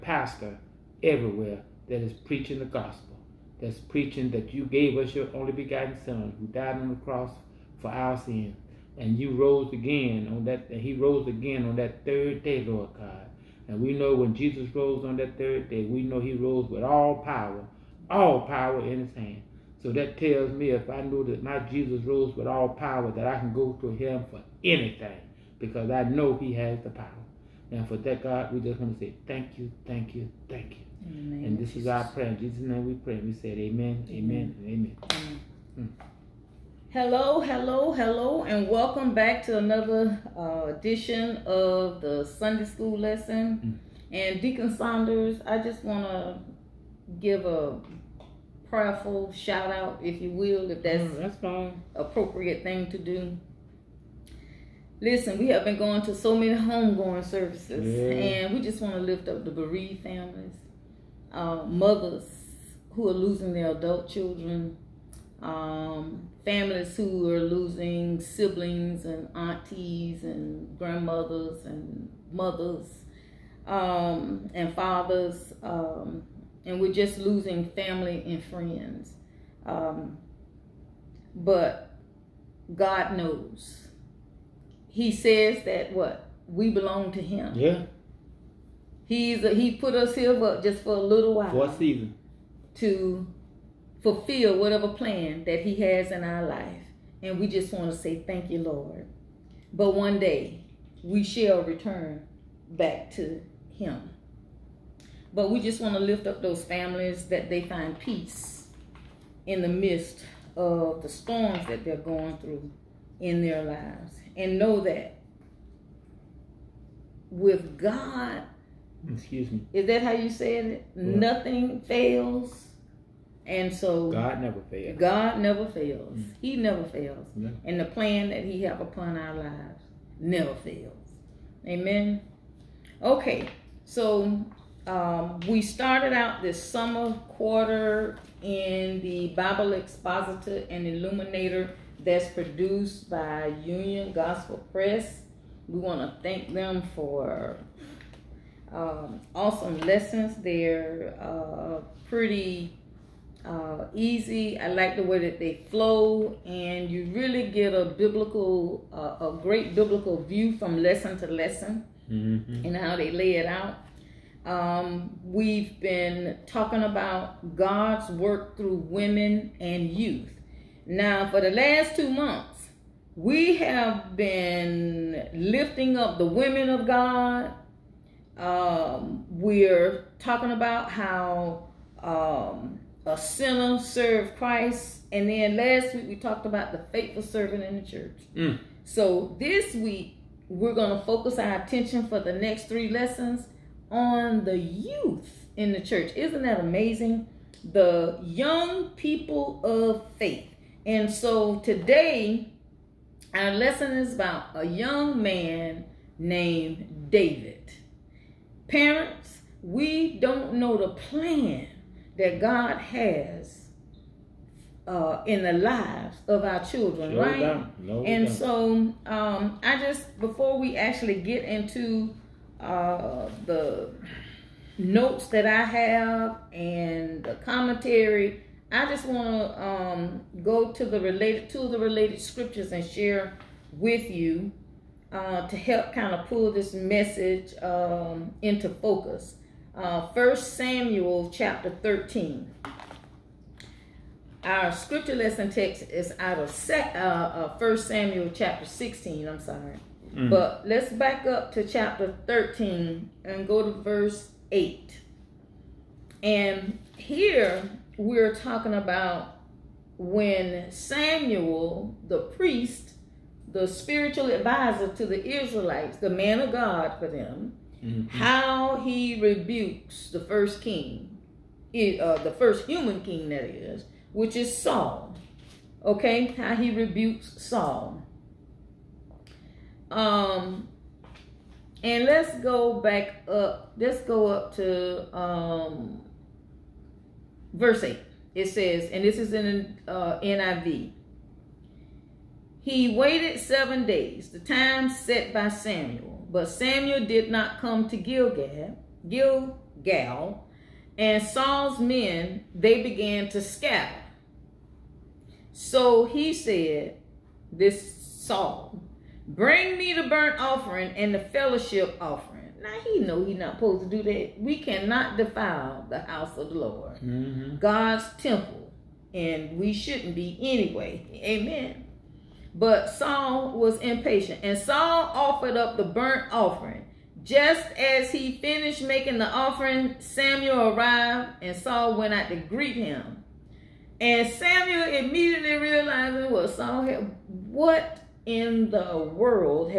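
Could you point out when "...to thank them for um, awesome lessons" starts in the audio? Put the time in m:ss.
2:26.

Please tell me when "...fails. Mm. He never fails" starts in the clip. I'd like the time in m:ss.
2:05.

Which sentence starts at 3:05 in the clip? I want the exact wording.
And then last week we talked about the faithful servant in the church.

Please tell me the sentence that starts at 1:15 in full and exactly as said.
Um, and we're just losing family and friends.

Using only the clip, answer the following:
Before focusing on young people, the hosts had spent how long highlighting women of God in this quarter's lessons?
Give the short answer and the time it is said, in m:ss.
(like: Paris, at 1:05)
two months, at 2:51.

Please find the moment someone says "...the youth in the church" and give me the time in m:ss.
3:14.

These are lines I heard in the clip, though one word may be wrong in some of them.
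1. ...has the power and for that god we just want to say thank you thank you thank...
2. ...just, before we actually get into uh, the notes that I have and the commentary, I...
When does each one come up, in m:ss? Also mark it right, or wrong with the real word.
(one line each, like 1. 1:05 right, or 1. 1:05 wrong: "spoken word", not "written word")
1. 0:26 right
2. 3:39 right.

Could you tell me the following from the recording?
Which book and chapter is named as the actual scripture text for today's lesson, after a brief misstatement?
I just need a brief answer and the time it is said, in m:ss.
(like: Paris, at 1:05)
1 Samuel 16, at 4:07.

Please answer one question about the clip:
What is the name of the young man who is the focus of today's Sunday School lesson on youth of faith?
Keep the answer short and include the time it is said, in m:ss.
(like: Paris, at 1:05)
David, at 3:27.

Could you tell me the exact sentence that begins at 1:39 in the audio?
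But one day we shall return back to Him.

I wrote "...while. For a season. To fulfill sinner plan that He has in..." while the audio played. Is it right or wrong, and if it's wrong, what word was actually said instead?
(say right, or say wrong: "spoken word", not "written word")
wrong: "whatever", not "sinner".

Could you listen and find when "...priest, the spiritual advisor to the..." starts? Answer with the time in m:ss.
4:22.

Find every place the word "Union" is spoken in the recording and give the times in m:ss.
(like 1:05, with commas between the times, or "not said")
2:23.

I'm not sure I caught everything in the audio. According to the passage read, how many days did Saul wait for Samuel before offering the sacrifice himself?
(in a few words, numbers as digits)
7.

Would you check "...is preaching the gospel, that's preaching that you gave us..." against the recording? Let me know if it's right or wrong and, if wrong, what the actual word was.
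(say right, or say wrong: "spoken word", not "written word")
right.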